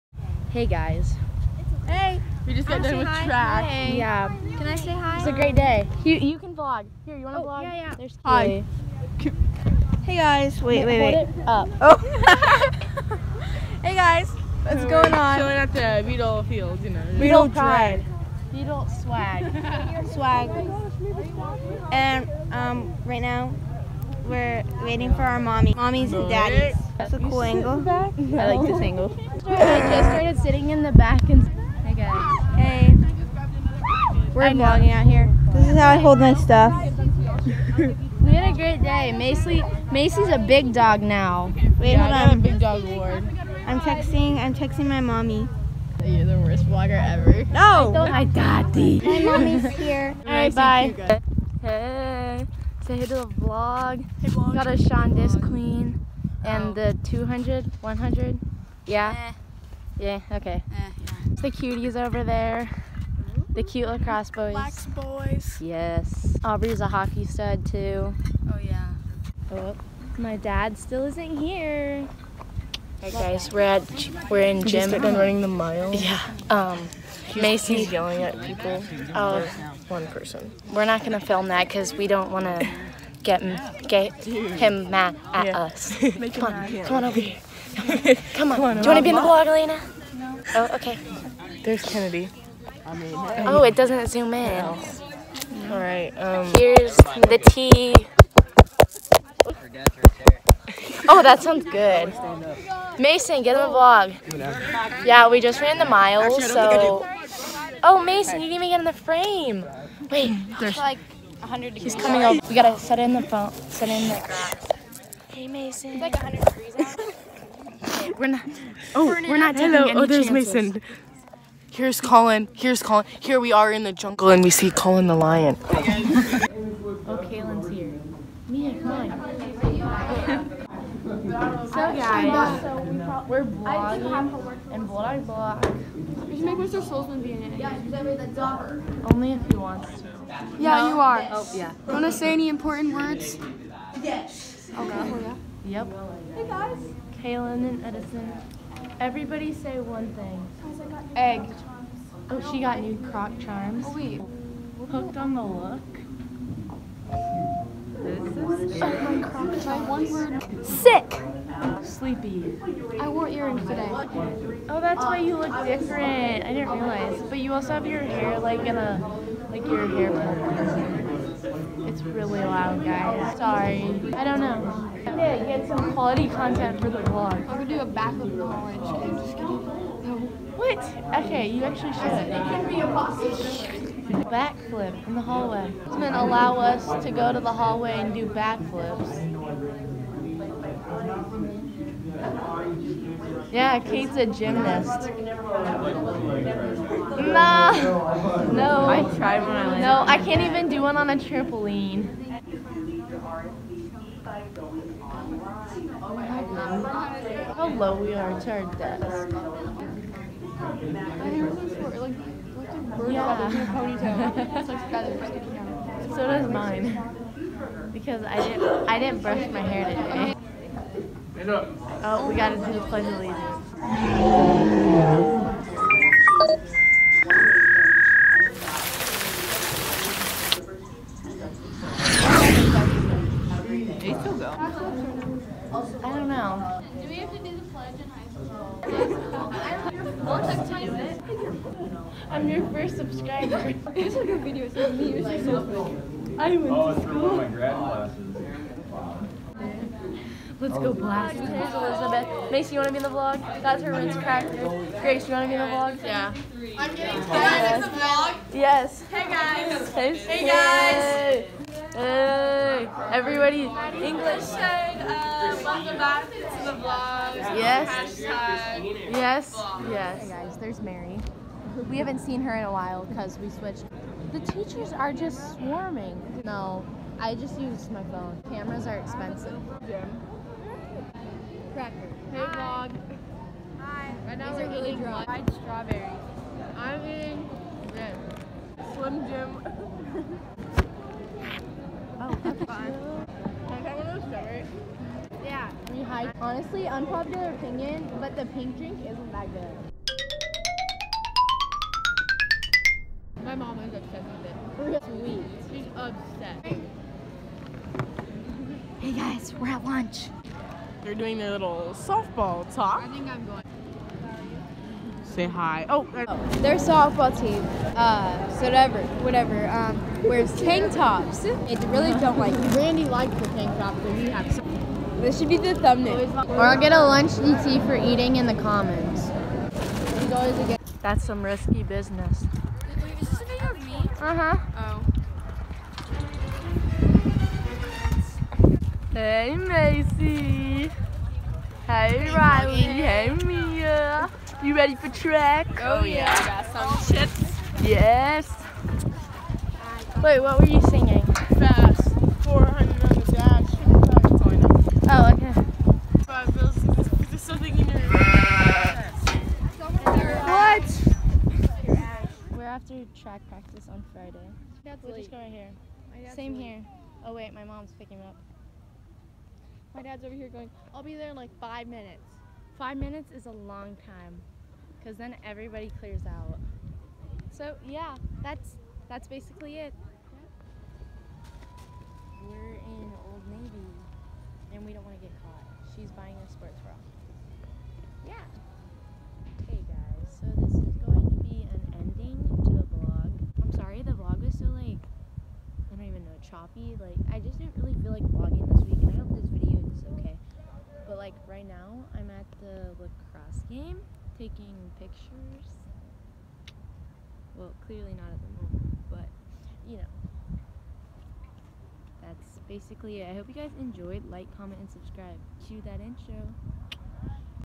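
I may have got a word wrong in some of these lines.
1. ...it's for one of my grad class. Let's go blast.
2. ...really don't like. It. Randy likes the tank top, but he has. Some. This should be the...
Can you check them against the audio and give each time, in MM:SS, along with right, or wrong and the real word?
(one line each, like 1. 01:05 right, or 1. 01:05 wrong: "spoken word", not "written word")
1. 04:06 right
2. 05:21 right.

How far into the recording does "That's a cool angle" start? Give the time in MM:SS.
00:26.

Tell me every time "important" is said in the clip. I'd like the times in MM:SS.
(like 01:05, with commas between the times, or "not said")
02:22.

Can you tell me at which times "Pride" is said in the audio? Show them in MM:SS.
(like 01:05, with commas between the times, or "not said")
00:17.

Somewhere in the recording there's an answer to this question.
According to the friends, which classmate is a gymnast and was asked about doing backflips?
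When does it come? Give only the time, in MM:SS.
03:13.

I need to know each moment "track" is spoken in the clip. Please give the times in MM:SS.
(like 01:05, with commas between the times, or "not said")
00:03, 05:45, 06:03.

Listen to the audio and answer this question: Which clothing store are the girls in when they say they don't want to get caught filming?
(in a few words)
Old Navy.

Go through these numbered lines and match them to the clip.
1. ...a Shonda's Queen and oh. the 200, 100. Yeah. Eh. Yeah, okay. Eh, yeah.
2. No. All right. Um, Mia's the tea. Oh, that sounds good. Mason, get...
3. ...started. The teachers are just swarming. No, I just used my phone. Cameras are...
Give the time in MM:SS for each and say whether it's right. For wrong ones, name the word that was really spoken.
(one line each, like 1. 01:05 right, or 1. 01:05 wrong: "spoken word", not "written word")
1. 00:54 right
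2. 01:34 wrong: "Here", not "Mia"
3. 04:33 wrong: "switched", not "started".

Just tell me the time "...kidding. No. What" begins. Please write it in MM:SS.
02:59.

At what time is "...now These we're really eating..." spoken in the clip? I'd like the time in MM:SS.
04:44.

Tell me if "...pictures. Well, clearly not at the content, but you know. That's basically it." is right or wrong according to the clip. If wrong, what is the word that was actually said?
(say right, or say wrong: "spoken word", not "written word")
wrong: "moment", not "content".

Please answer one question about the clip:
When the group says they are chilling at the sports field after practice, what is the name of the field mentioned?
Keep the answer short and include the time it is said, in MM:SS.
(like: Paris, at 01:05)
Beetle Field, at 00:16.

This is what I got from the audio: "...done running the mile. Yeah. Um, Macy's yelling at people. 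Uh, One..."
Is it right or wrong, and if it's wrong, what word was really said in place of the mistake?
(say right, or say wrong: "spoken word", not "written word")
right.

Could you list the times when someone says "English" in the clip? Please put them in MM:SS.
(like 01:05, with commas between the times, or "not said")
04:24.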